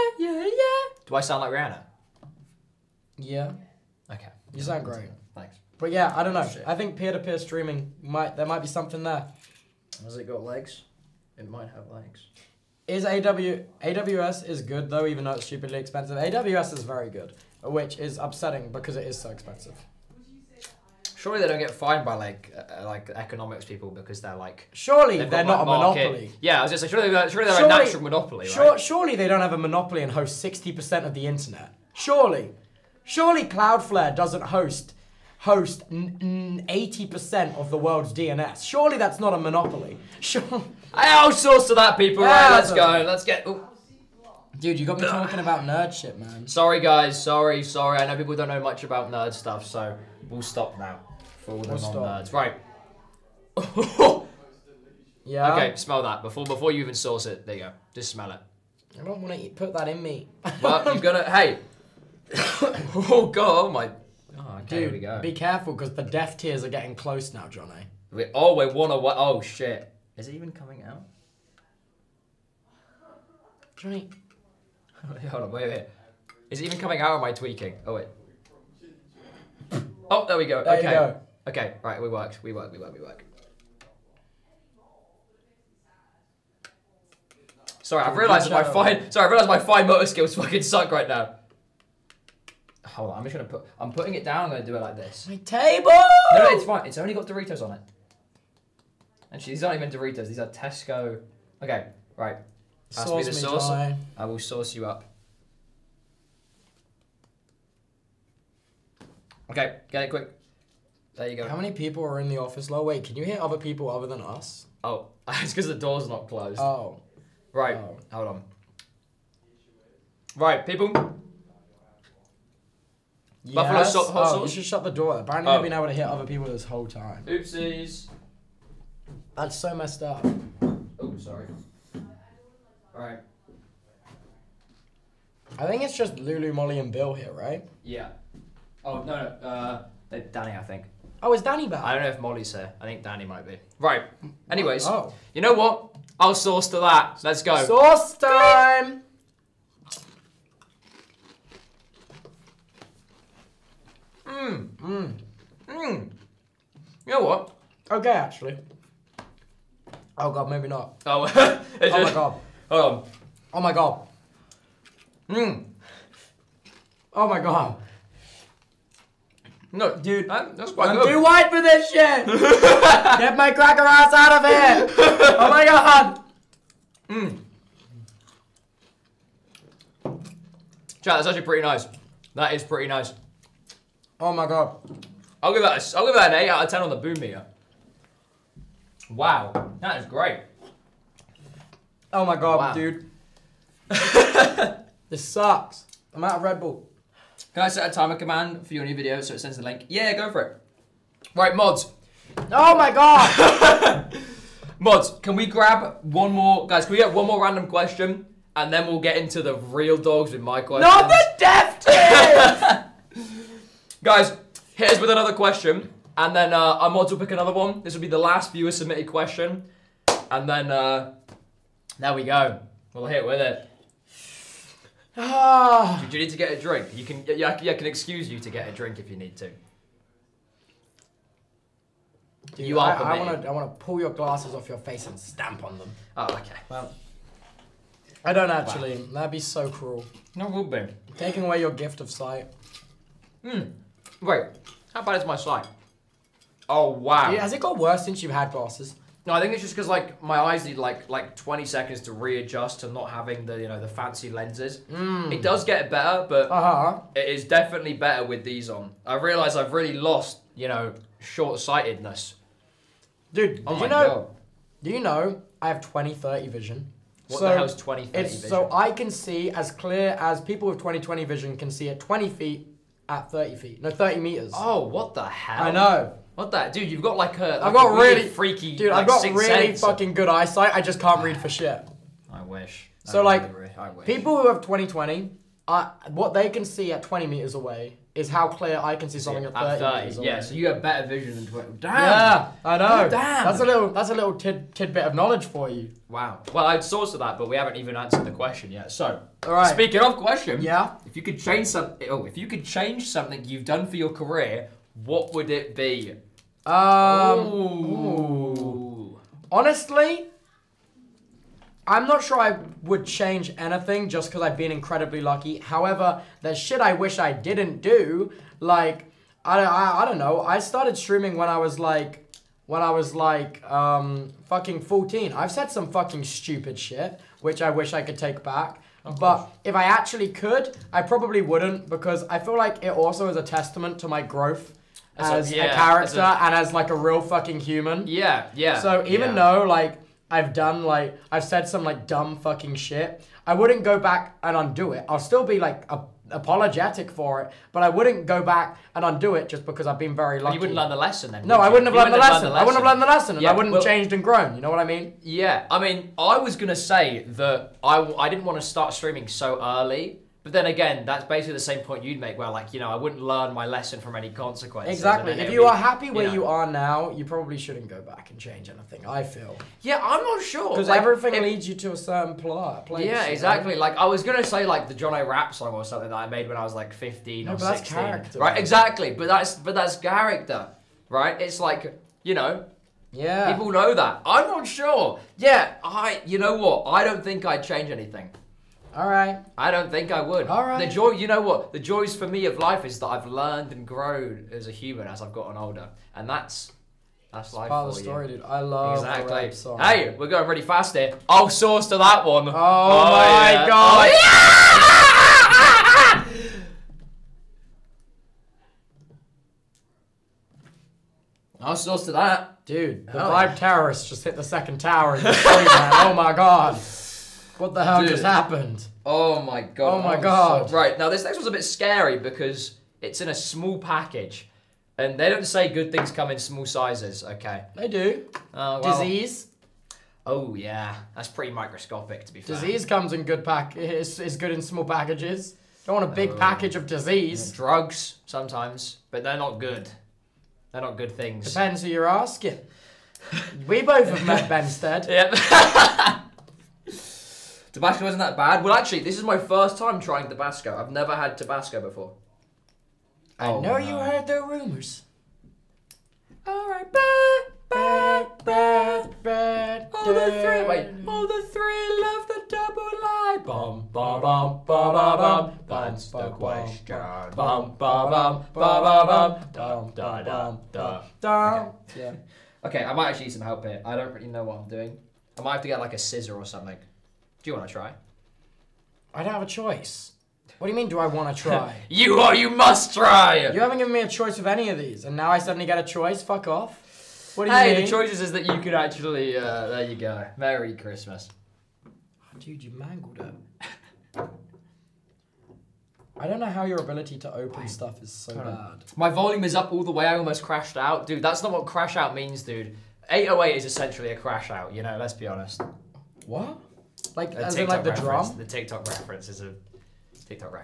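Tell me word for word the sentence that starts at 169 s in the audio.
No, dude, I'm, that's quite I'm good.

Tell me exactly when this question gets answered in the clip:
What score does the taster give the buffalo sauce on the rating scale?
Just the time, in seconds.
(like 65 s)
186 s.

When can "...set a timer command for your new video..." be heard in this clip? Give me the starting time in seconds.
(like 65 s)
197 s.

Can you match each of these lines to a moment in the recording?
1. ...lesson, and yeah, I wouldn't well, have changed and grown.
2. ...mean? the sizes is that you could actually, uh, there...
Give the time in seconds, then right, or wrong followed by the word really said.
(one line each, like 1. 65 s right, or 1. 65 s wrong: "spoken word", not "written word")
1. 353 s right
2. 487 s wrong: "choices", not "sizes".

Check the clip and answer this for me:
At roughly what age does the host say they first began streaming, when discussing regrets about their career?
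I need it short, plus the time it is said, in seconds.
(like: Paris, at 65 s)
14, at 324 s.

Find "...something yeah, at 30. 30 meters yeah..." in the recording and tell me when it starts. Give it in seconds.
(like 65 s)
289 s.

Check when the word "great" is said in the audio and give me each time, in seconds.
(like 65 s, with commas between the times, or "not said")
4 s, 190 s.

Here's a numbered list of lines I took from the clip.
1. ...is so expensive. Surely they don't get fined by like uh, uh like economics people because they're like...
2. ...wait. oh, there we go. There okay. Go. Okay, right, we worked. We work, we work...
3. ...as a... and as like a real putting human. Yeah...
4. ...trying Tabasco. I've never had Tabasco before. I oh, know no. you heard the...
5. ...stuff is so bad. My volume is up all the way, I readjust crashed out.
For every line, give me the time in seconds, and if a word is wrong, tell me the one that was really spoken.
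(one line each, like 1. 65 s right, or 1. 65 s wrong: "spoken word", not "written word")
1. 19 s right
2. 77 s right
3. 336 s wrong: "fucking", not "putting"
4. 450 s right
5. 497 s wrong: "almost", not "readjust".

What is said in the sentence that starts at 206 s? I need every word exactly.
Guys, can we get one more random question?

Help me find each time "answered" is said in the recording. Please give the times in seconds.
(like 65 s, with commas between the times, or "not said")
297 s.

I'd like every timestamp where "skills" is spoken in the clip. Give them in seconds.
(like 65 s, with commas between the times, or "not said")
90 s.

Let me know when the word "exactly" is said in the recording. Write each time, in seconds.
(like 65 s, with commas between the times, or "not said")
364 s, 373 s, 378 s, 398 s.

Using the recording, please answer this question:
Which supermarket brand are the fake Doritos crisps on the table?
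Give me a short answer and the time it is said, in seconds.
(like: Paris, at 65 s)
Tesco, at 100 s.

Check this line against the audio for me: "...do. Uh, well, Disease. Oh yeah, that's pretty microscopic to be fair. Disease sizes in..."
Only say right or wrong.
wrong.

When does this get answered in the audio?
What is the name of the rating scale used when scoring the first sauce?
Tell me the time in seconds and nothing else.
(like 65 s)
186 s.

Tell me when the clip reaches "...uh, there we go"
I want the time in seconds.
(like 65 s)
220 s.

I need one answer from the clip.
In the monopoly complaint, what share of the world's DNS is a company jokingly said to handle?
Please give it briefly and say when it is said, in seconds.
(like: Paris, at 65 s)
80%, at 35 s.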